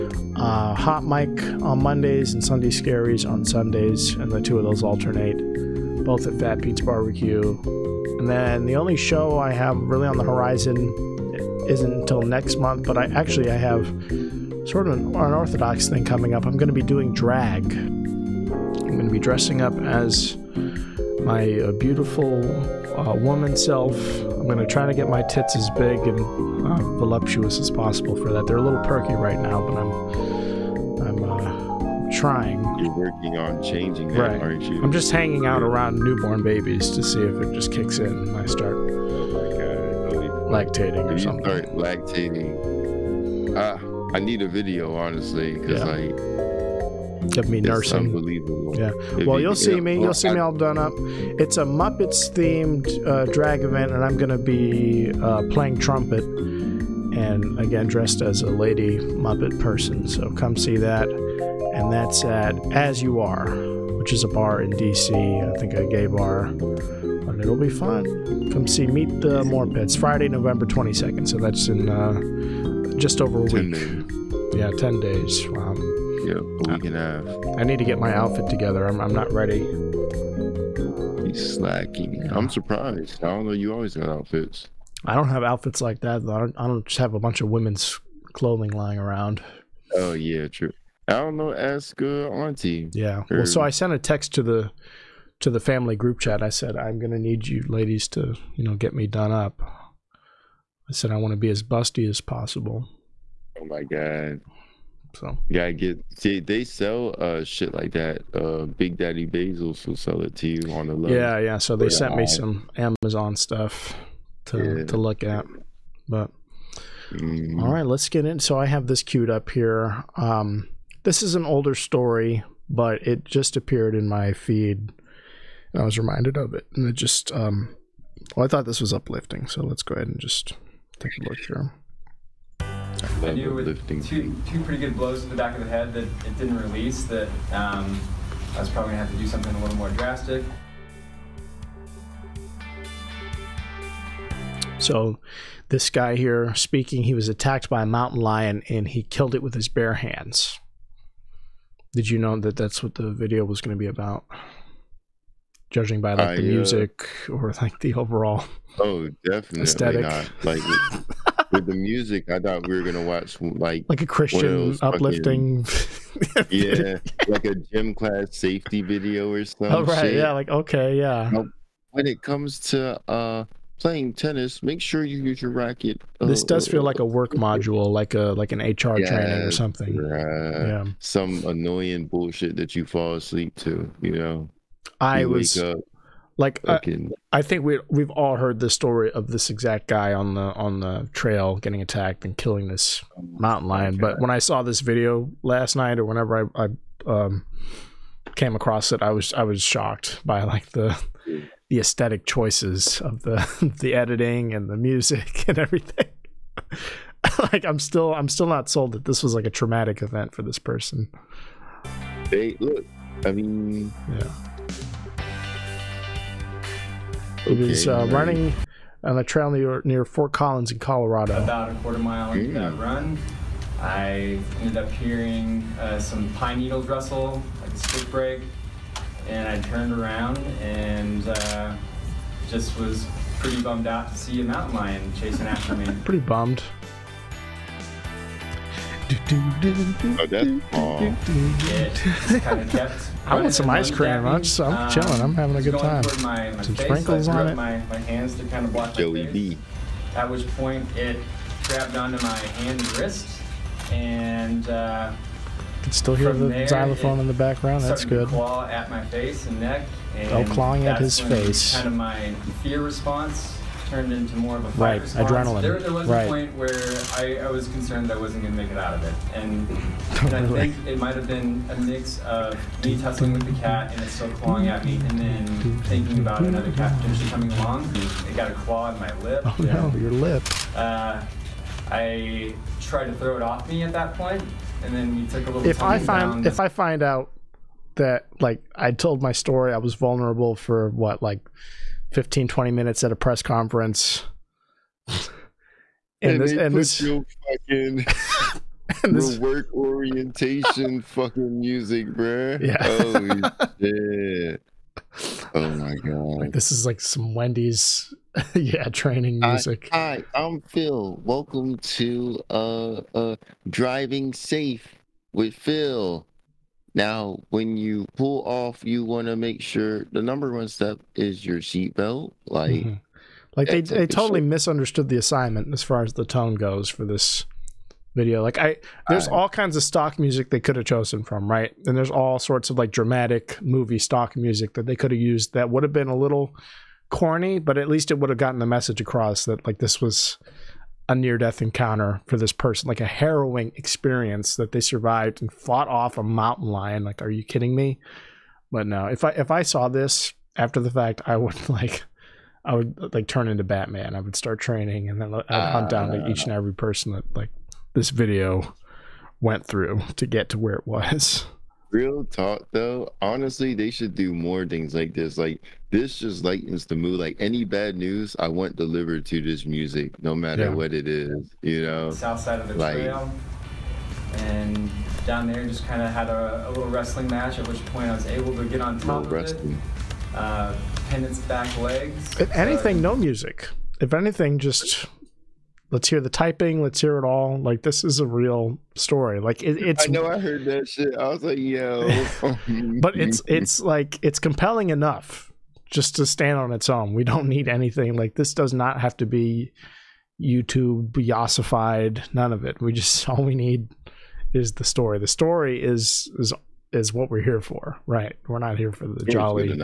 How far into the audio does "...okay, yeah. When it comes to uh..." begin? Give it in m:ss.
2:50.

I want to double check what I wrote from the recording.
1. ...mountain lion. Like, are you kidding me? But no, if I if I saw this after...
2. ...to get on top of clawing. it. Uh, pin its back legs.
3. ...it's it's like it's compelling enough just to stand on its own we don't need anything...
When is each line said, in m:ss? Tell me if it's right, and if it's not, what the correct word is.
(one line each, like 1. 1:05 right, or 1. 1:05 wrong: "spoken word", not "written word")
1. 5:46 right
2. 6:18 wrong: "wrestling", not "clawing"
3. 6:33 right.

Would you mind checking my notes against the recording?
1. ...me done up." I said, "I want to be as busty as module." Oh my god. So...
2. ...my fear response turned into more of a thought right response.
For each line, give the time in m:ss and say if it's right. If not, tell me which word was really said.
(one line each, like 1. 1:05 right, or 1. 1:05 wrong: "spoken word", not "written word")
1. 1:38 wrong: "possible", not "module"
2. 4:21 wrong: "fight", not "thought".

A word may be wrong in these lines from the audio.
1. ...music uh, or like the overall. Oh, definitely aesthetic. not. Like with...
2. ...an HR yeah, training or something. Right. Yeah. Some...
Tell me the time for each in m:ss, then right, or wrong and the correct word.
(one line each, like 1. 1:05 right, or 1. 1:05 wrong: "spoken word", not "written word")
1. 2:36 right
2. 2:58 right.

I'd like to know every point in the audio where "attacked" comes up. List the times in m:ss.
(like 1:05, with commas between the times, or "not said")
2:27, 3:11.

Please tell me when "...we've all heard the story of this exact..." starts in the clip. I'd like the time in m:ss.
3:07.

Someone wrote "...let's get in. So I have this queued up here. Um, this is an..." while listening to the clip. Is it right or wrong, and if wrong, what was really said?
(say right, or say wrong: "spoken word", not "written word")
right.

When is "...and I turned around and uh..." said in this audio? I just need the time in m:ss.
3:49.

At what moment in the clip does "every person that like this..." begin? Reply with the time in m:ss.
5:56.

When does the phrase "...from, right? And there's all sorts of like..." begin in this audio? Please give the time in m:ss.
5:31.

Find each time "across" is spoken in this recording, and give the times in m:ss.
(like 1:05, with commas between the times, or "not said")
3:18, 5:38.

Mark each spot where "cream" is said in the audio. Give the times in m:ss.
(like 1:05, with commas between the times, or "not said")
4:03.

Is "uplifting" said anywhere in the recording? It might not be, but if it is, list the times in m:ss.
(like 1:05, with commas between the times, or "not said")
2:08, 2:44.